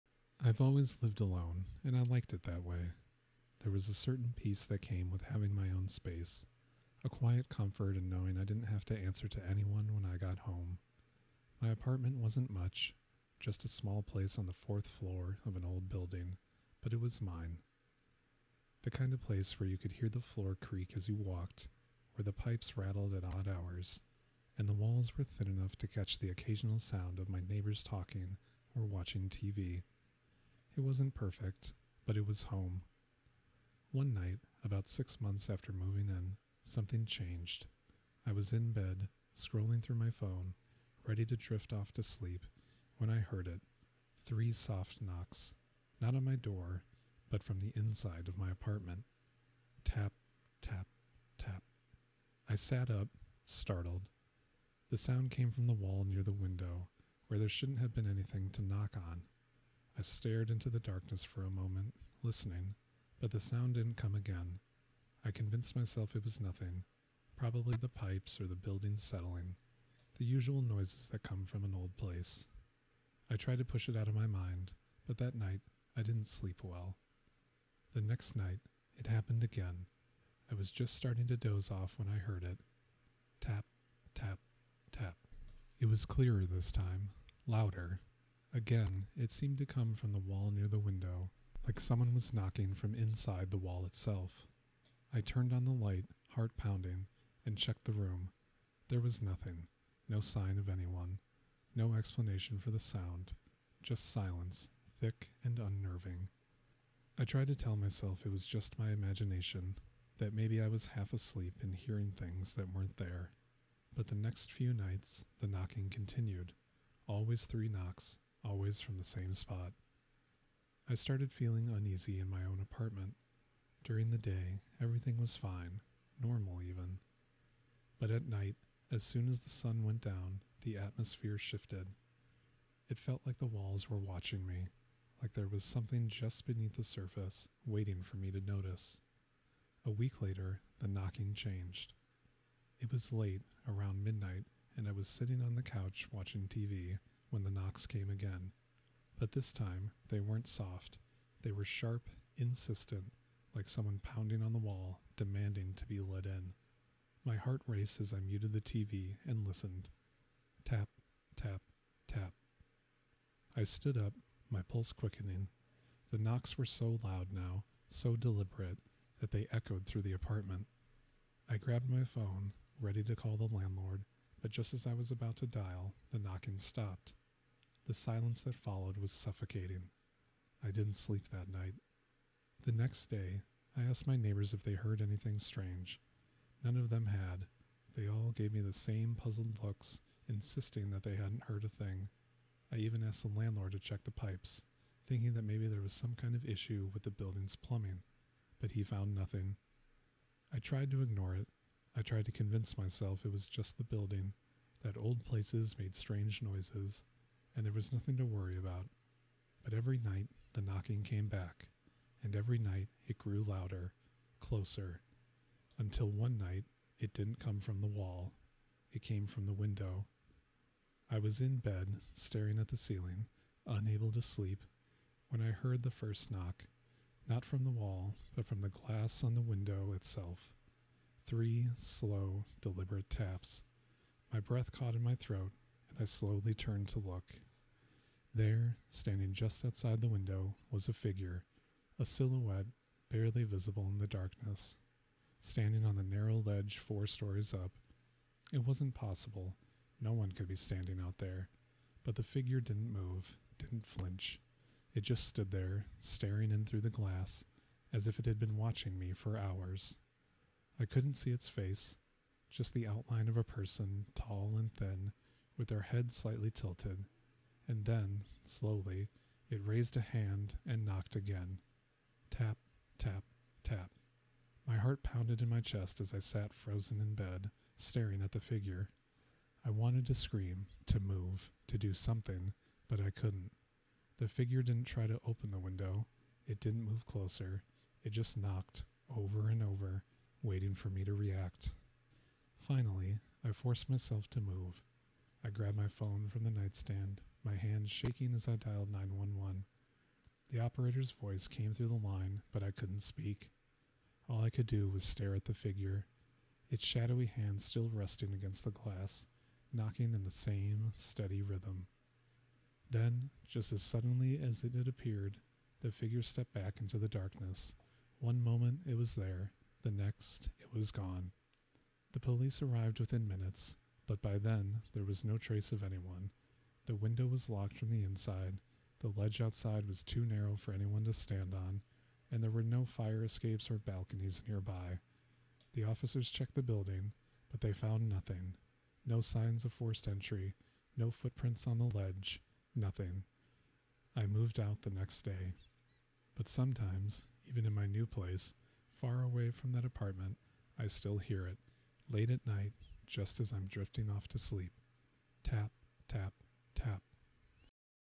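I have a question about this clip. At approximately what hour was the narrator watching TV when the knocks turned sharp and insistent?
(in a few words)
midnight.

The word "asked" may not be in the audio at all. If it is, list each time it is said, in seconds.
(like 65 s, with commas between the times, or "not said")
183 s, 193 s.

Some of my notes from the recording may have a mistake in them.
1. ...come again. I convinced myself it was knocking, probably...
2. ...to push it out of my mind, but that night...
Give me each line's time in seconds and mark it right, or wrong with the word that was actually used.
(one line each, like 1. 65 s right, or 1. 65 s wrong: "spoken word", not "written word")
1. 63 s wrong: "nothing", not "knocking"
2. 73 s right.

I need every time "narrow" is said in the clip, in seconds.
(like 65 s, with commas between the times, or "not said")
246 s, 330 s.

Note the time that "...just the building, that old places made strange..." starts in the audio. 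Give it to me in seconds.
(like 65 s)
203 s.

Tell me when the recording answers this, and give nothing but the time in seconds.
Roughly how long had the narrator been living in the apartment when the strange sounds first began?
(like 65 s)
34 s.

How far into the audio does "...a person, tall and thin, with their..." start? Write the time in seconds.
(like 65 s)
263 s.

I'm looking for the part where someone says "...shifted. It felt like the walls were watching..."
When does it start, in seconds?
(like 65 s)
131 s.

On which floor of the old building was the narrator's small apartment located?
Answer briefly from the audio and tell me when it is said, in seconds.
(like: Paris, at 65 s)
fourth floor, at 14 s.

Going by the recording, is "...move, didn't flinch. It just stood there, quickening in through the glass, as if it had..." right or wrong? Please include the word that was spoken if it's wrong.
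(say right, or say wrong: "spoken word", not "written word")
wrong: "staring", not "quickening".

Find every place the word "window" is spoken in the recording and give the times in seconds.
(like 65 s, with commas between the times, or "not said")
56 s, 90 s, 219 s, 229 s, 240 s, 285 s, 326 s.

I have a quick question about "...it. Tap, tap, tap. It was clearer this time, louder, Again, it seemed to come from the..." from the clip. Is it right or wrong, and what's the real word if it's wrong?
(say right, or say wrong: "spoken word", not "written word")
right.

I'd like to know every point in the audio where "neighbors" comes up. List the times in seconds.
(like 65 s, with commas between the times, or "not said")
27 s, 184 s.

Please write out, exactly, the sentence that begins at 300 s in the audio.
The operator's voice came through the line, but I couldn't speak.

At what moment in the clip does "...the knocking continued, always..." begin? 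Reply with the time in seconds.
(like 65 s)
115 s.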